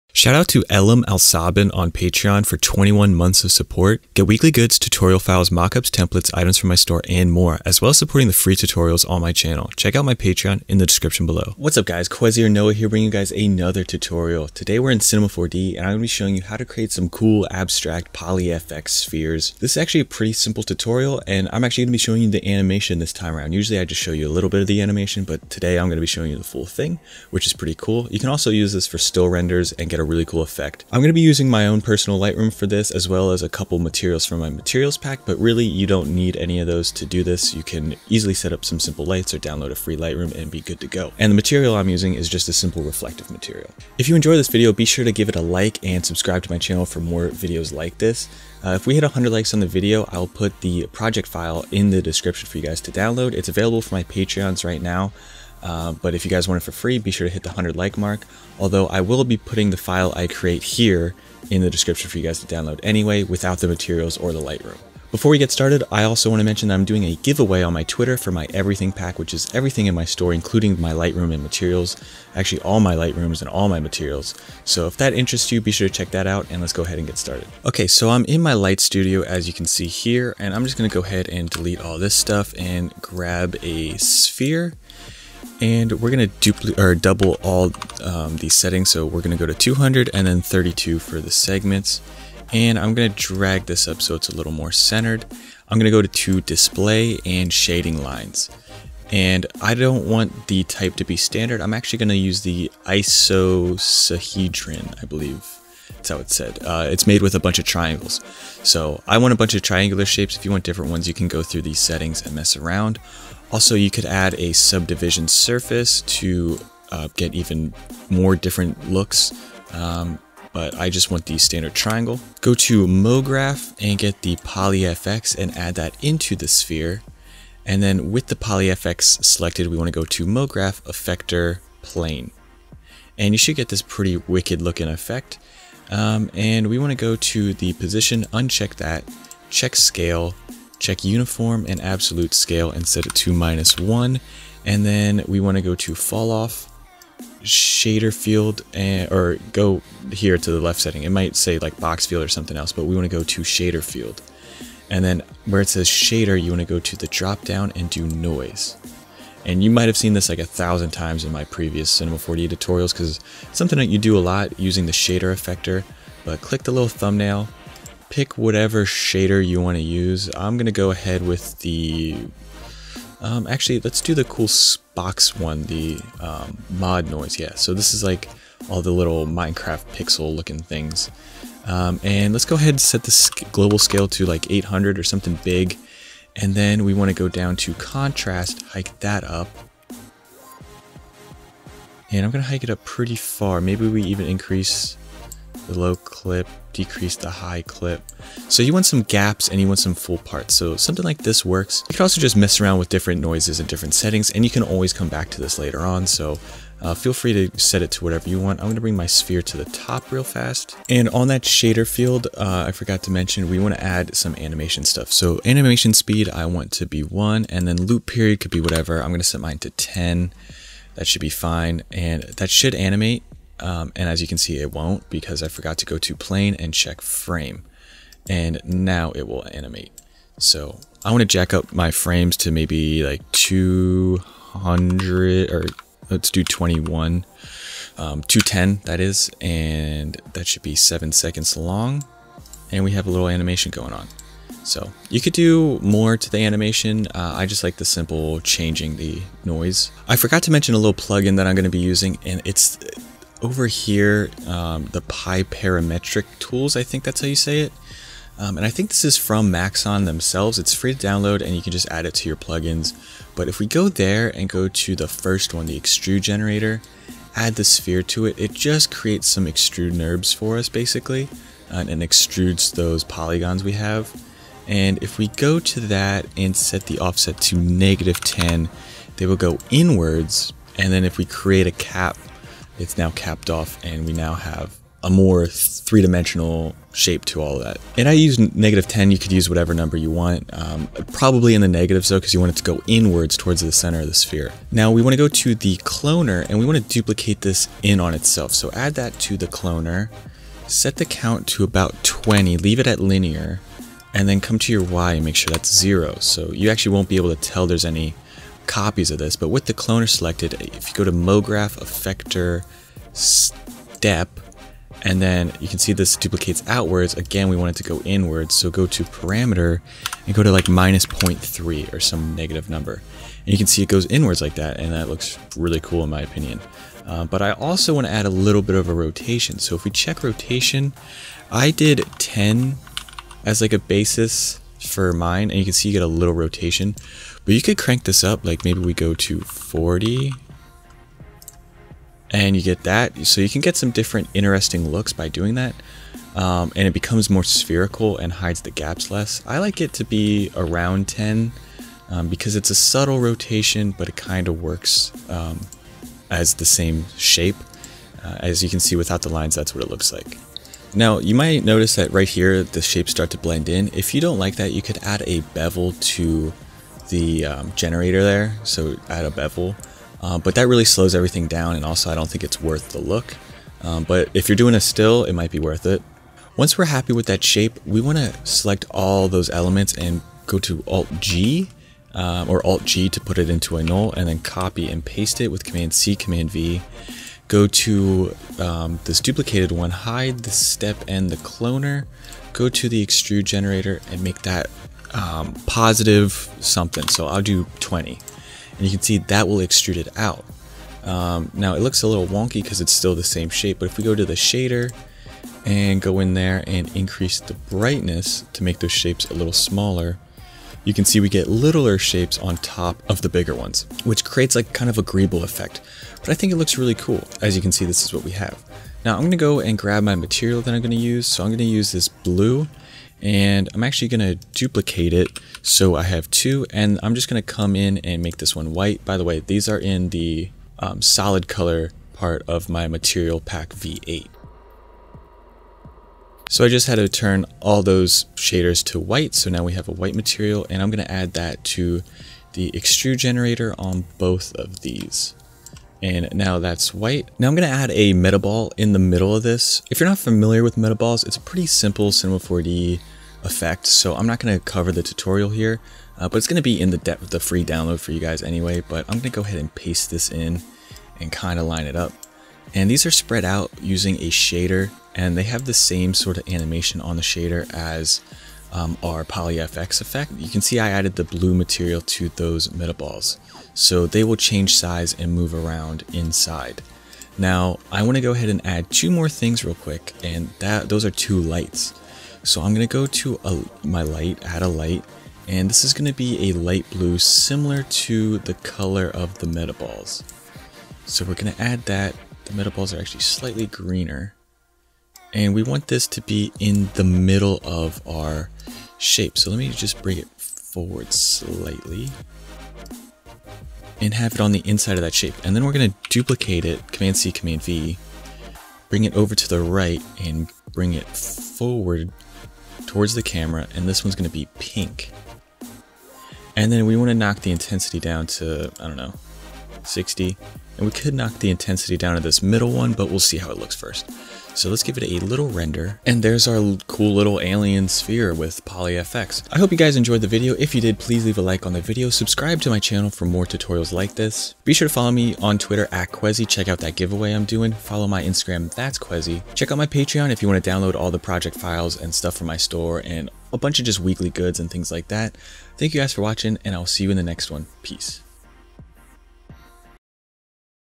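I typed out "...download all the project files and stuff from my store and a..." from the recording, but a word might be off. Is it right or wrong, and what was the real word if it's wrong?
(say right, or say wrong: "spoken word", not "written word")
right.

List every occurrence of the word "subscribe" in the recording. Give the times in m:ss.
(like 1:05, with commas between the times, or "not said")
0:46, 8:52.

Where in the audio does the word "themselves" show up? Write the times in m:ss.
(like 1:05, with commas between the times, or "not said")
4:20.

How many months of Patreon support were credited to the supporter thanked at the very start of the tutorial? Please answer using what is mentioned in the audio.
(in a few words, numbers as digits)
21.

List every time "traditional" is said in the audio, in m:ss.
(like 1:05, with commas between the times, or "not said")
not said.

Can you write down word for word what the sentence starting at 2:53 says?
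Um, actually, let's do the cool Spox one, the um, mod noise.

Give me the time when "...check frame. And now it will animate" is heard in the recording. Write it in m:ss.
3:46.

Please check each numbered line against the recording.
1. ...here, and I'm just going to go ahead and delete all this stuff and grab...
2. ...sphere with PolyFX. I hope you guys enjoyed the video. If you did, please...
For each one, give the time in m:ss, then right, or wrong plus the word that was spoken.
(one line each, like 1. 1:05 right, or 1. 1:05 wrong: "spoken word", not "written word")
1. 1:19 right
2. 8:47 right.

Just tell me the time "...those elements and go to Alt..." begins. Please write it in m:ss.
6:19.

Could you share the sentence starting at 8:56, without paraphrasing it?
Check out that giveaway I'm doing.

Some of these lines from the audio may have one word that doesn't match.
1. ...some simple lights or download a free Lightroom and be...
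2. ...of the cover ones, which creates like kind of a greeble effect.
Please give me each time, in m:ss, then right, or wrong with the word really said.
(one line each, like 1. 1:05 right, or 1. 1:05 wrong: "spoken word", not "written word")
1. 0:38 right
2. 6:53 wrong: "bigger", not "cover".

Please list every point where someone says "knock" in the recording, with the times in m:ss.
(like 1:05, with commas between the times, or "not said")
8:37, 8:41.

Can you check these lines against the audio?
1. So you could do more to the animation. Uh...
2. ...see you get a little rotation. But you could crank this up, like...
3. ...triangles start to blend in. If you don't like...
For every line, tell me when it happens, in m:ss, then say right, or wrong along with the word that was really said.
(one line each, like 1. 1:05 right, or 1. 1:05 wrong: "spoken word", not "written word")
1. 4:04 right
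2. 5:35 right
3. 6:02 wrong: "shapes", not "triangles".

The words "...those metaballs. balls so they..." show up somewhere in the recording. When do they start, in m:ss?
7:52.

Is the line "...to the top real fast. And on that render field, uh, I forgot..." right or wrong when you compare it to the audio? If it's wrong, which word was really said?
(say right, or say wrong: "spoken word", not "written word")
wrong: "shader", not "render".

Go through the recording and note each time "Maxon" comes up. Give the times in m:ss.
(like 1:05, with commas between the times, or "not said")
4:19.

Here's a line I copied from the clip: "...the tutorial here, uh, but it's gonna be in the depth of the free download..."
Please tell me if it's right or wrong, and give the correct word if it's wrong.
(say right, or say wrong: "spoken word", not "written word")
right.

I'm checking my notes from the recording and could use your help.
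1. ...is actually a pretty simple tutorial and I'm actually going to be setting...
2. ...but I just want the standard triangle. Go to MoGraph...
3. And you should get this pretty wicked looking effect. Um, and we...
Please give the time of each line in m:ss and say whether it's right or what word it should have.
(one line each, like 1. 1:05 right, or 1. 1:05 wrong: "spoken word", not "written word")
1. 0:19 wrong: "showing", not "setting"
2. 2:00 right
3. 2:13 right.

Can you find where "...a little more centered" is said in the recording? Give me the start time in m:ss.
1:34.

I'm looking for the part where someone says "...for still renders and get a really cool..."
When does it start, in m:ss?
0:28.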